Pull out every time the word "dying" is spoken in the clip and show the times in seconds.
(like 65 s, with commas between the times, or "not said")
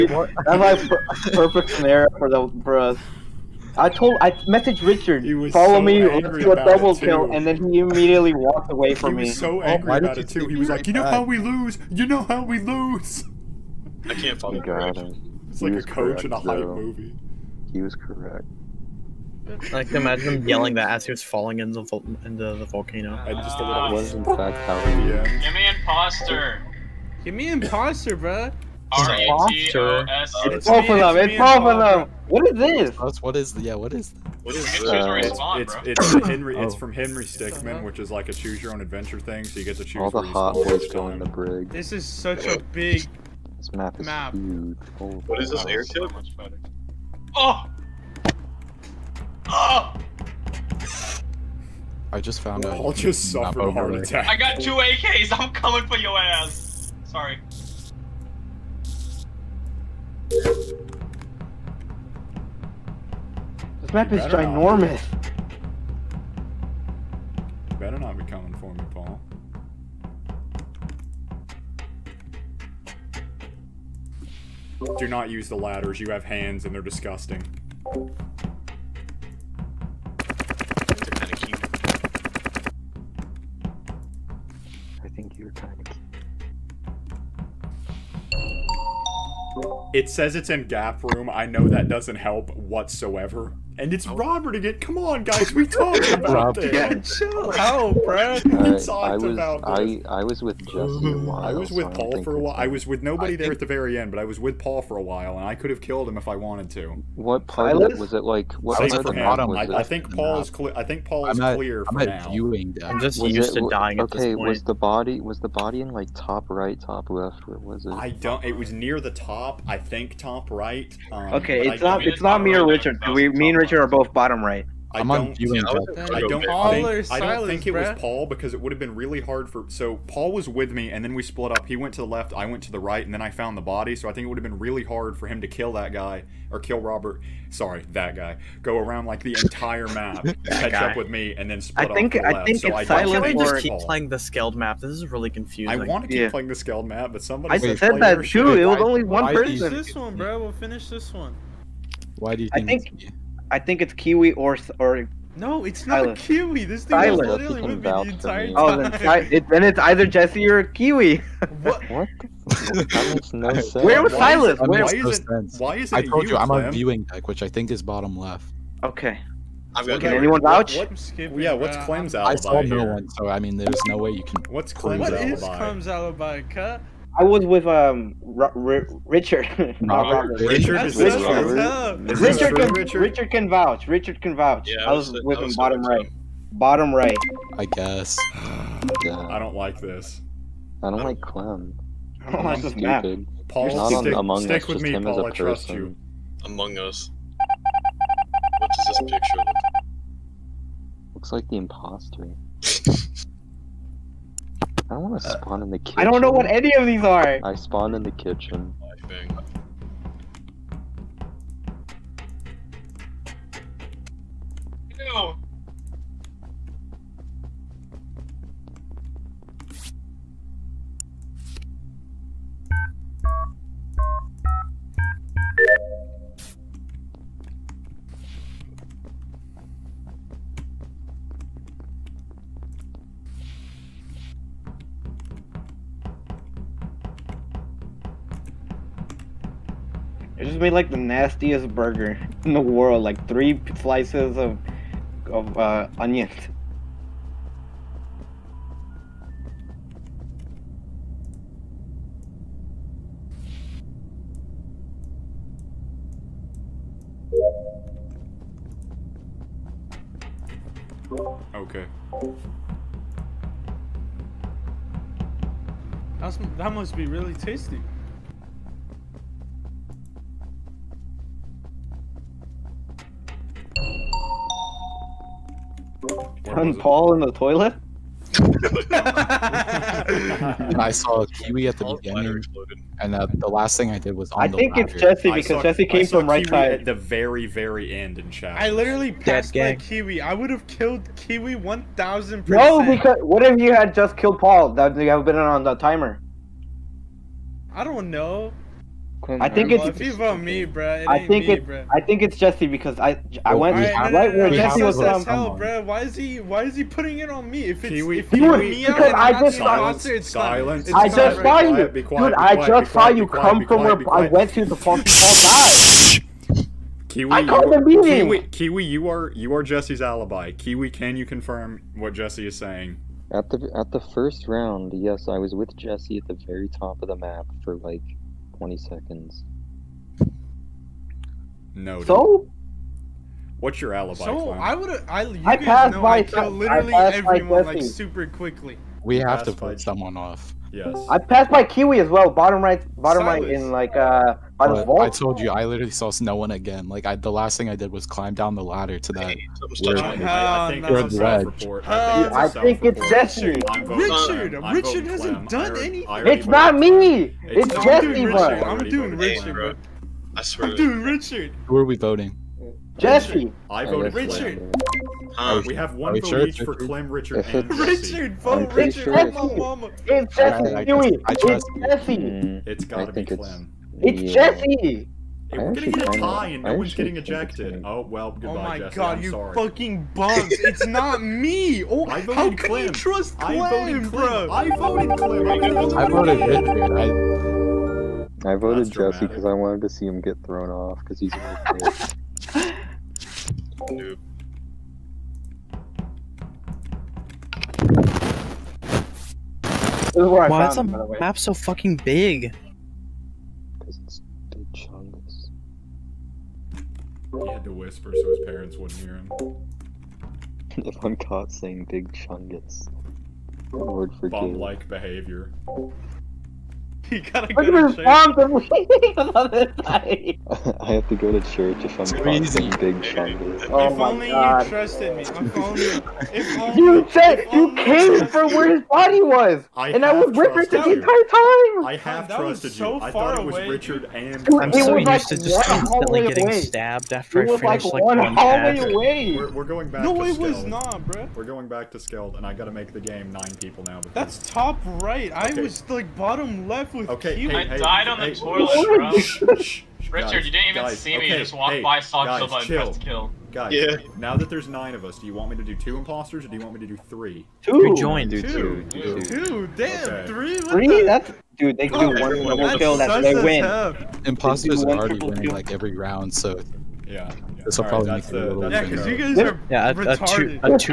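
113 s.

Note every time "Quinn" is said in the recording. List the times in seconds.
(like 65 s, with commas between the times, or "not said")
299 s.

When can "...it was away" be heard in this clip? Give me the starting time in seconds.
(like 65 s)
433 s.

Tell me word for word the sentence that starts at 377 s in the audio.
Oh well, goodbye, Oh my Jesse.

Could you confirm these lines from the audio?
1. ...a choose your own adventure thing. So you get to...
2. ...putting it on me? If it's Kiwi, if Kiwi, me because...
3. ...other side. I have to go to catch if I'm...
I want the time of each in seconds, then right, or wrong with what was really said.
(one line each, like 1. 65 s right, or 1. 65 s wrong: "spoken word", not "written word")
1. 38 s right
2. 306 s right
3. 419 s wrong: "church", not "catch".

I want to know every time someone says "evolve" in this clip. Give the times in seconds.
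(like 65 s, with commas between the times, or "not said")
not said.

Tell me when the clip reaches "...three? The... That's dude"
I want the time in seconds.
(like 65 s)
460 s.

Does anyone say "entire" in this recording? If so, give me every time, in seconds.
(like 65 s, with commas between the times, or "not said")
139 s, 158 s, 430 s.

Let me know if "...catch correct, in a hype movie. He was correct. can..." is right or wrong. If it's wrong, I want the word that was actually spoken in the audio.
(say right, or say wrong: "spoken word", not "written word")
wrong: "coach", not "catch".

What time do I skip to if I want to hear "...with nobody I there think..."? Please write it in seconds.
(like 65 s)
102 s.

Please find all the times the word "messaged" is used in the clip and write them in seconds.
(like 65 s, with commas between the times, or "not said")
4 s.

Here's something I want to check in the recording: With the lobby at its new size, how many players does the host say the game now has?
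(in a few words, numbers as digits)
9.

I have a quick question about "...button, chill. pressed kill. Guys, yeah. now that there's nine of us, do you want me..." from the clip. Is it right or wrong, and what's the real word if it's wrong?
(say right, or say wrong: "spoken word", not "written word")
right.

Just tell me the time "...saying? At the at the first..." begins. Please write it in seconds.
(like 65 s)
322 s.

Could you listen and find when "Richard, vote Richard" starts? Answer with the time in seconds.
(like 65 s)
368 s.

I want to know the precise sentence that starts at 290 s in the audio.
I would have killed Kiwi one thousand percent.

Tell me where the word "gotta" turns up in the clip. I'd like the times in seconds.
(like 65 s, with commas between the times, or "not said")
372 s, 417 s, 442 s.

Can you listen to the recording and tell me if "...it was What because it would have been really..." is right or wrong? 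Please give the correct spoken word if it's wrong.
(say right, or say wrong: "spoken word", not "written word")
wrong: "Paul", not "What".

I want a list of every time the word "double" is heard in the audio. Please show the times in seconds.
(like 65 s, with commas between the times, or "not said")
6 s, 462 s.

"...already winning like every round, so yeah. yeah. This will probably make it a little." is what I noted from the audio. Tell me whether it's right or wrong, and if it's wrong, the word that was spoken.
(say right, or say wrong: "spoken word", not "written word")
right.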